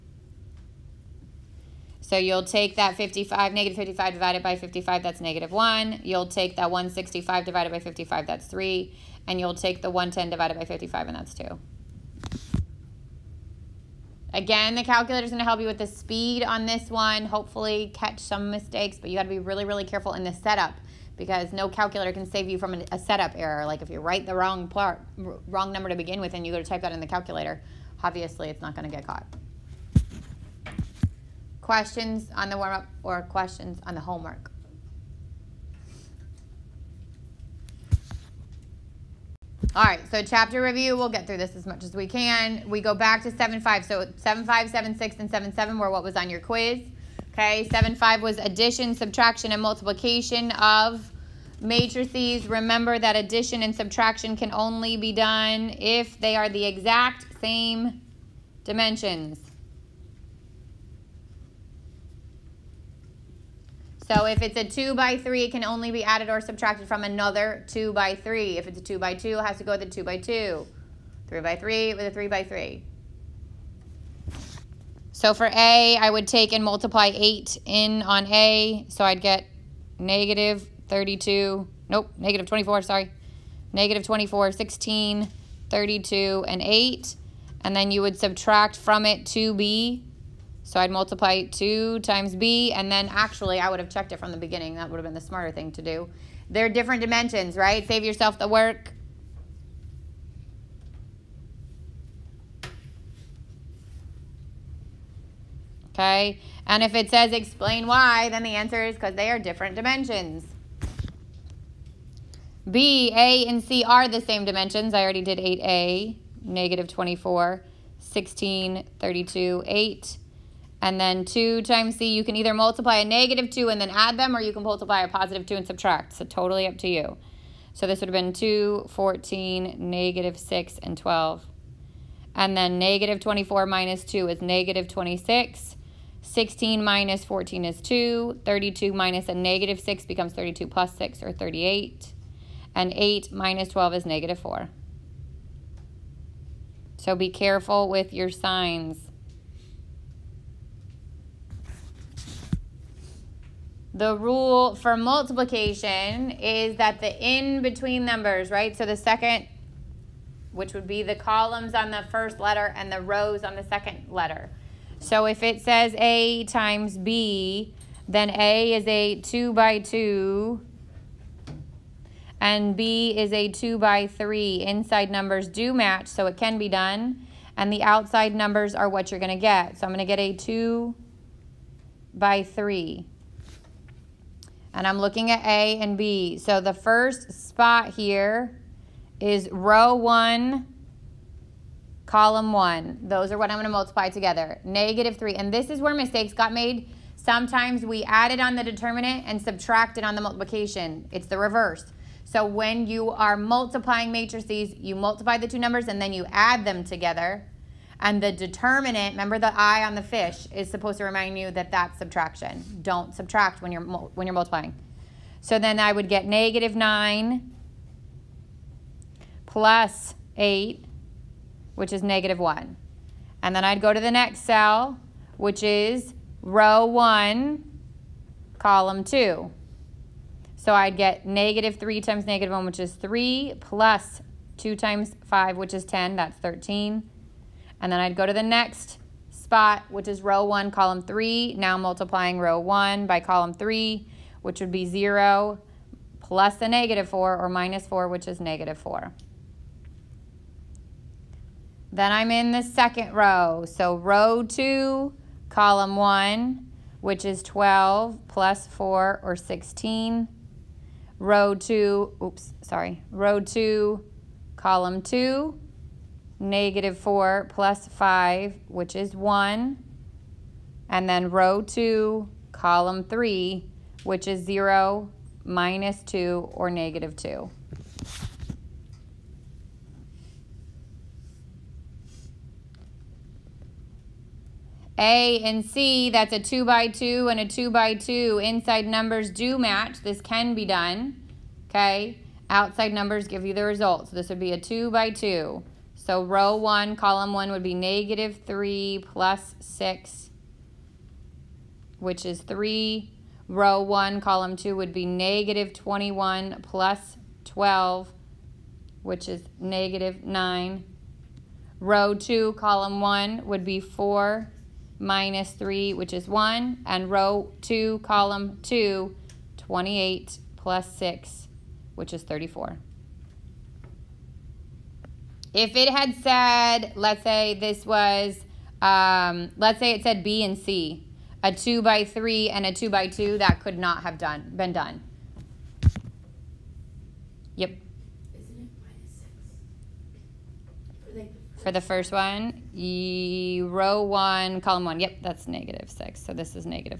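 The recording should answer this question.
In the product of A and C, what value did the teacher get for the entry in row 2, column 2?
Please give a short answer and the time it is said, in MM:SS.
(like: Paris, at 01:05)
34, at 05:22.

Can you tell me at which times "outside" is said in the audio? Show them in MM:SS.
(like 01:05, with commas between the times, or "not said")
02:57, 04:52.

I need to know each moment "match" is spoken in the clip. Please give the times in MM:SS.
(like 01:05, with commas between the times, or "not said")
02:55, 04:49.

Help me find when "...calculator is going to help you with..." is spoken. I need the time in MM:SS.
00:14.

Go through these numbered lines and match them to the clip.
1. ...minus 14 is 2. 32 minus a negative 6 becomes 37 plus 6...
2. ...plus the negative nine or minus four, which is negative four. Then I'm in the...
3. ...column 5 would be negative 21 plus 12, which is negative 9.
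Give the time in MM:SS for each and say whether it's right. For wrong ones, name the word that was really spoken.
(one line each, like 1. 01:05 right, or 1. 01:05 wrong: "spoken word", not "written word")
1. 02:16 wrong: "32", not "37"
2. 04:06 wrong: "four", not "nine"
3. 05:04 wrong: "2", not "5".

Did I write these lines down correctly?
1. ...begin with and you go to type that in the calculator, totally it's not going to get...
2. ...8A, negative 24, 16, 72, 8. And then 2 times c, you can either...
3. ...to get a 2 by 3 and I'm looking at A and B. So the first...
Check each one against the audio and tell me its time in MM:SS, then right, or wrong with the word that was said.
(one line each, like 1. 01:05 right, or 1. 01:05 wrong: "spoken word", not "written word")
1. 00:25 wrong: "obviously", not "totally"
2. 01:55 wrong: "32", not "72"
3. 03:00 right.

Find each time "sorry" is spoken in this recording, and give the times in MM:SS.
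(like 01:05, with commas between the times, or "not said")
01:22, 04:22.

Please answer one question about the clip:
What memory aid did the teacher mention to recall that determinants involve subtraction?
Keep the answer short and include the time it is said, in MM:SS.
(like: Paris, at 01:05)
the I on the fish, at 03:29.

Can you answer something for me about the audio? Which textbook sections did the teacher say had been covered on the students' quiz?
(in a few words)
7-5, 7-6, and 7-7.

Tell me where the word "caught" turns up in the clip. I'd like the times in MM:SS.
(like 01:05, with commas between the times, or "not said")
00:29.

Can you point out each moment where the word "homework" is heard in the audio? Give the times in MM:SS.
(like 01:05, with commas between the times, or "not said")
00:33.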